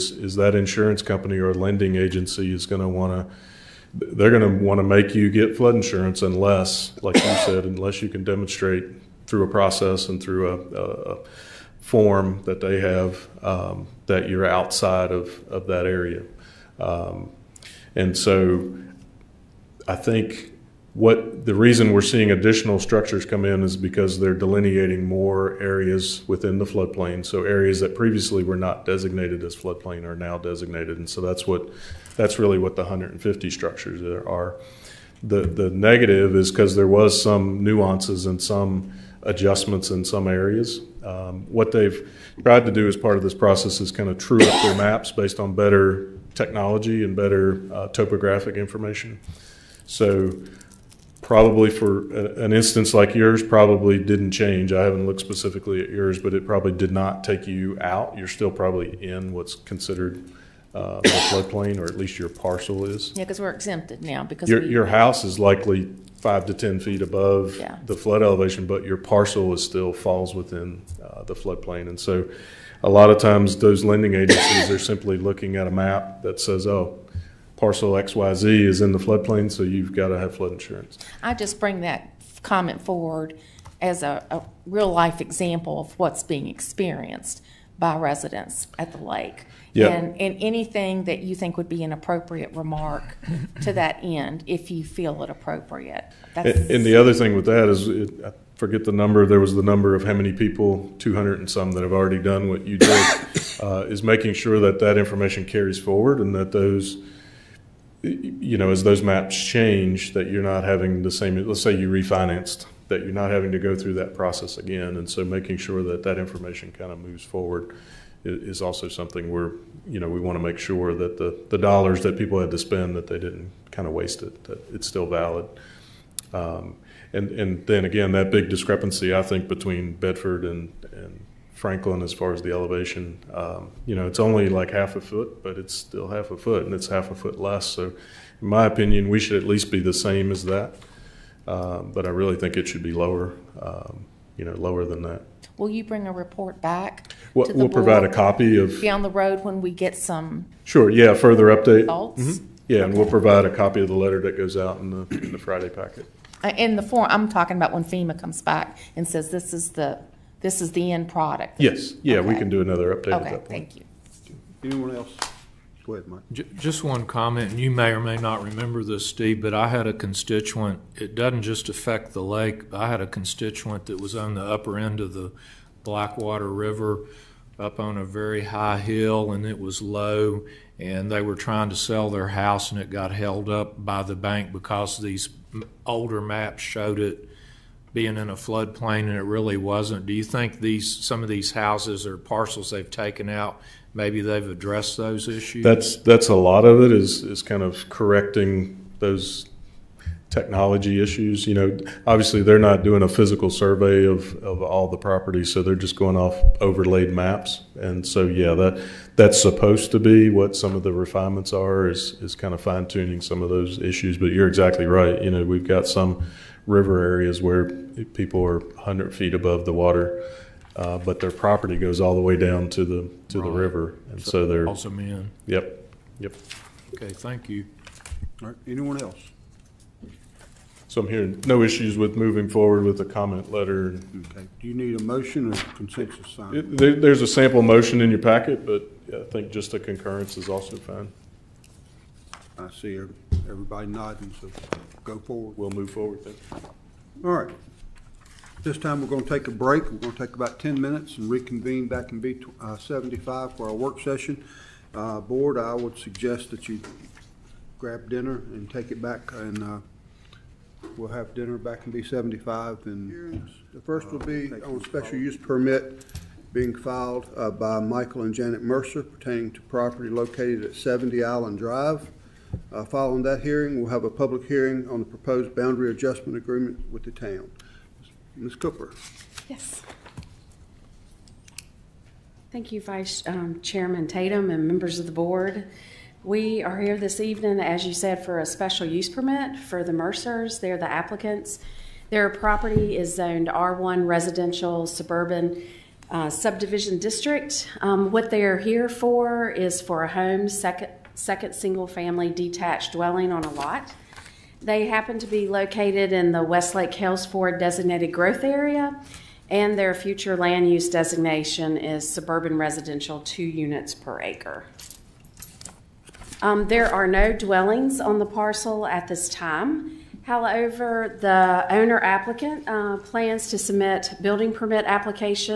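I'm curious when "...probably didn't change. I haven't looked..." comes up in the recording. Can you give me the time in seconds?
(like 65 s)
53 s.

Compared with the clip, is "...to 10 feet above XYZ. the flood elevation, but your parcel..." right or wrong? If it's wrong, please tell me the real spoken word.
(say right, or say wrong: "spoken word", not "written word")
wrong: "Yeah", not "XYZ".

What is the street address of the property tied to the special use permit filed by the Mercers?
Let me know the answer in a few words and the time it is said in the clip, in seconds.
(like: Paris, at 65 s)
70 Island Drive, at 270 s.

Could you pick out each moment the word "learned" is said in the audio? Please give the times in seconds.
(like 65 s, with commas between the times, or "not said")
not said.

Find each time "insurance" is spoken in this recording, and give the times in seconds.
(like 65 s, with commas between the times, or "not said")
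0 s, 5 s, 80 s.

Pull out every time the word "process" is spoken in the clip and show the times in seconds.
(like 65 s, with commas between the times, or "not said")
9 s, 43 s, 114 s.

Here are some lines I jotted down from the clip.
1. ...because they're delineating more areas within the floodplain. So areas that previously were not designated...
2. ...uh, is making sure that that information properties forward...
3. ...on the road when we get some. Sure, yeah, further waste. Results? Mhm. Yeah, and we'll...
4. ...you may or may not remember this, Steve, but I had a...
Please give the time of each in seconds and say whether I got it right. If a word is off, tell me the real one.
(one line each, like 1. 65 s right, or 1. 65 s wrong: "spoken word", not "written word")
1. 23 s right
2. 103 s wrong: "carries", not "properties"
3. 148 s wrong: "update", not "waste"
4. 167 s right.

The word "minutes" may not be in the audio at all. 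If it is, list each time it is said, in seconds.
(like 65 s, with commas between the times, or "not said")
250 s.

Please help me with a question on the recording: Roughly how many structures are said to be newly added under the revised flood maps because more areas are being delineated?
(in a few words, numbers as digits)
150.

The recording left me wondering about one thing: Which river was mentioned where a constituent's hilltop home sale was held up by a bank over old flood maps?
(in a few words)
Blackwater River.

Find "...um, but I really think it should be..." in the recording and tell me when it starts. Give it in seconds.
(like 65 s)
141 s.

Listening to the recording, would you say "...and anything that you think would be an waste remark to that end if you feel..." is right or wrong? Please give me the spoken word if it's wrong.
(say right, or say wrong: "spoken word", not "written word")
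wrong: "appropriate", not "waste".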